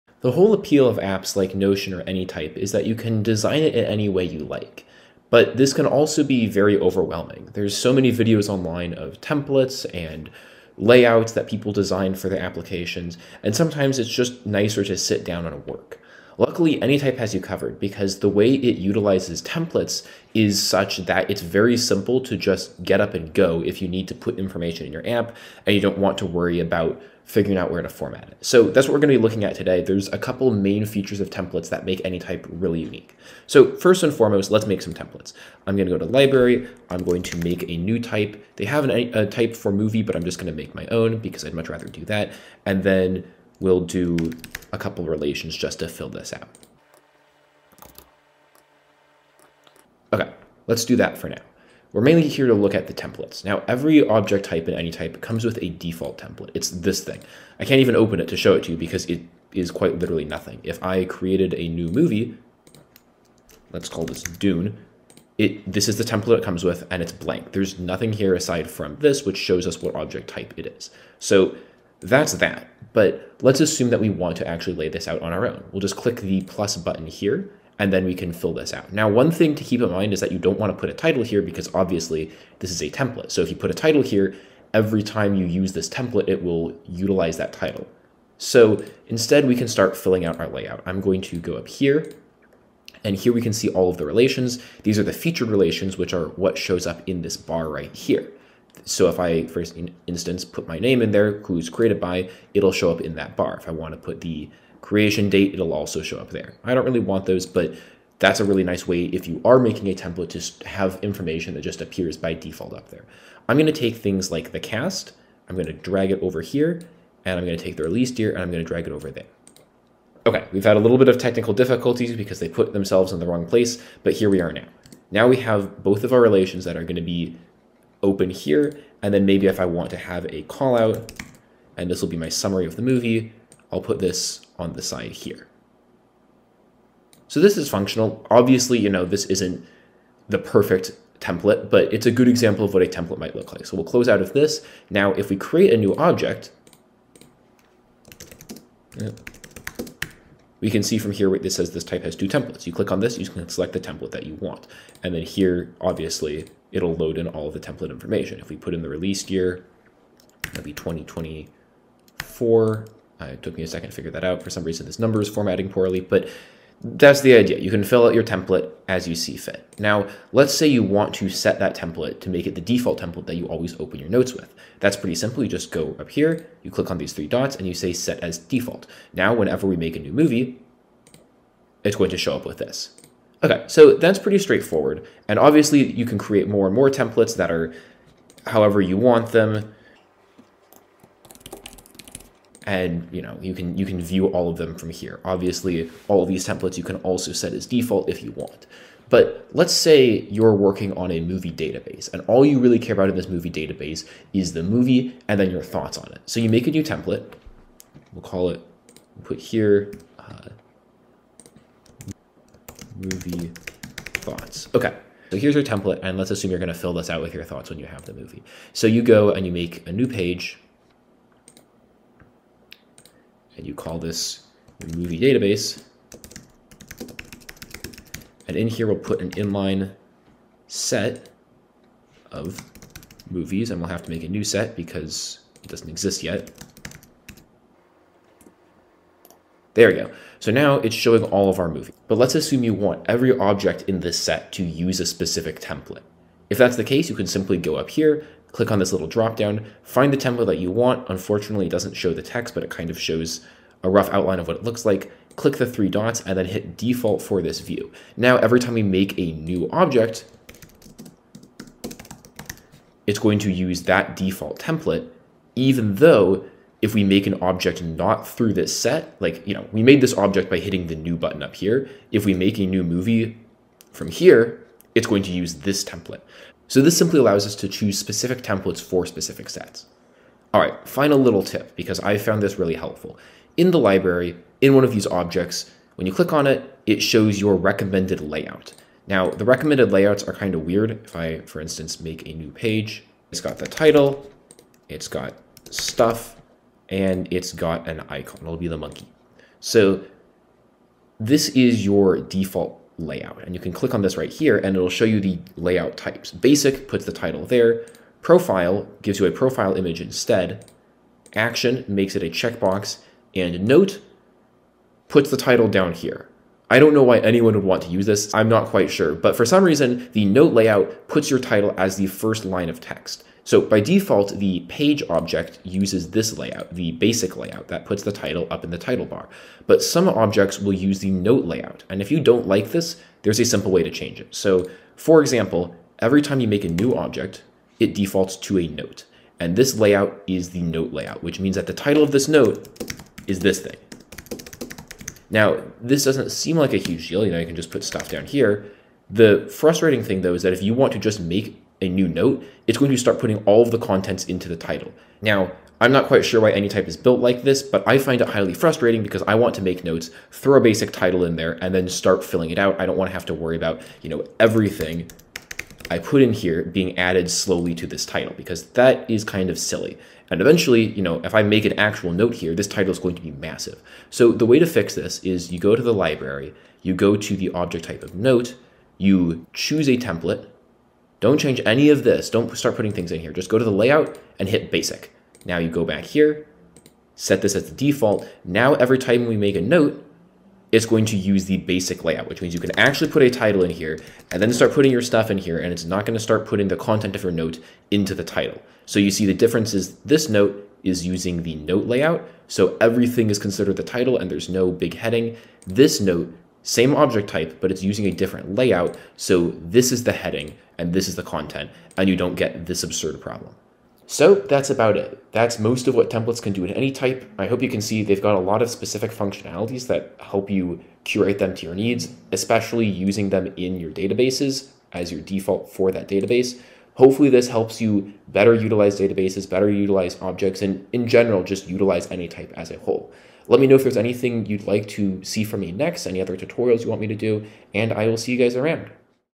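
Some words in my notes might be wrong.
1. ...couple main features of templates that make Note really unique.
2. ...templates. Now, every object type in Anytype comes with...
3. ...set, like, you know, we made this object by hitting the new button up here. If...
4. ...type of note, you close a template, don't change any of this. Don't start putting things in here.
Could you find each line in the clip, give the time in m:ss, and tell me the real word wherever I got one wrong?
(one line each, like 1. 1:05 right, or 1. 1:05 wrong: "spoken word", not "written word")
1. 0:30 wrong: "Anytype", not "Note"
2. 0:52 right
3. 4:28 right
4. 6:17 wrong: "choose", not "close".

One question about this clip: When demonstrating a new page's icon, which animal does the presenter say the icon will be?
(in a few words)
Monkey.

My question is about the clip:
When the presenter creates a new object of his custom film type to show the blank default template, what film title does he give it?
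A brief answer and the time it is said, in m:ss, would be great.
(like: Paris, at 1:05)
Dune, at 1:04.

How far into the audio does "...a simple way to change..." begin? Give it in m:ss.
5:33.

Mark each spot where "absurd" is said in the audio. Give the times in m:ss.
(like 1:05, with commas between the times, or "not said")
6:52.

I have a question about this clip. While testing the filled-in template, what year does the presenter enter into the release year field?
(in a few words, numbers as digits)
2024.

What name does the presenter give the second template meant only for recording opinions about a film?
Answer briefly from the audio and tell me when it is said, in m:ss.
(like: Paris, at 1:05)
Movie thoughts, at 3:33.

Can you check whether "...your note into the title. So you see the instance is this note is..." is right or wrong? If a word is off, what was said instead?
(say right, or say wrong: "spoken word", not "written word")
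wrong: "difference", not "instance".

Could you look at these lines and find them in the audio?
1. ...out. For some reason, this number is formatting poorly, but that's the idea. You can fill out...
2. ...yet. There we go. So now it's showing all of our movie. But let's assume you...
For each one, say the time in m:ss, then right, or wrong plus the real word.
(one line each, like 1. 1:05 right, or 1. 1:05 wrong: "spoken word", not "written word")
1. 2:44 right
2. 3:56 right.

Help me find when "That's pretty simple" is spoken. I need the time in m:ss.
2:54.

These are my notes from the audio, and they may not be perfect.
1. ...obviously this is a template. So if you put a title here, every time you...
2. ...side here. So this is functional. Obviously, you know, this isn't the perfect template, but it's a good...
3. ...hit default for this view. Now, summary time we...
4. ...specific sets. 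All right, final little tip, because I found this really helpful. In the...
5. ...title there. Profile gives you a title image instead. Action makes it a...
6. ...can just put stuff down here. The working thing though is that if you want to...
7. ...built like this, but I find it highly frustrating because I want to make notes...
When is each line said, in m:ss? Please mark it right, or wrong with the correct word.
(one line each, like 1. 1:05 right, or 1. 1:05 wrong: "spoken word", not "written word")
1. 1:21 right
2. 2:14 right
3. 4:16 wrong: "every", not "summary"
4. 4:39 right
5. 5:07 wrong: "profile", not "title"
6. 5:47 wrong: "frustrating", not "working"
7. 5:56 right.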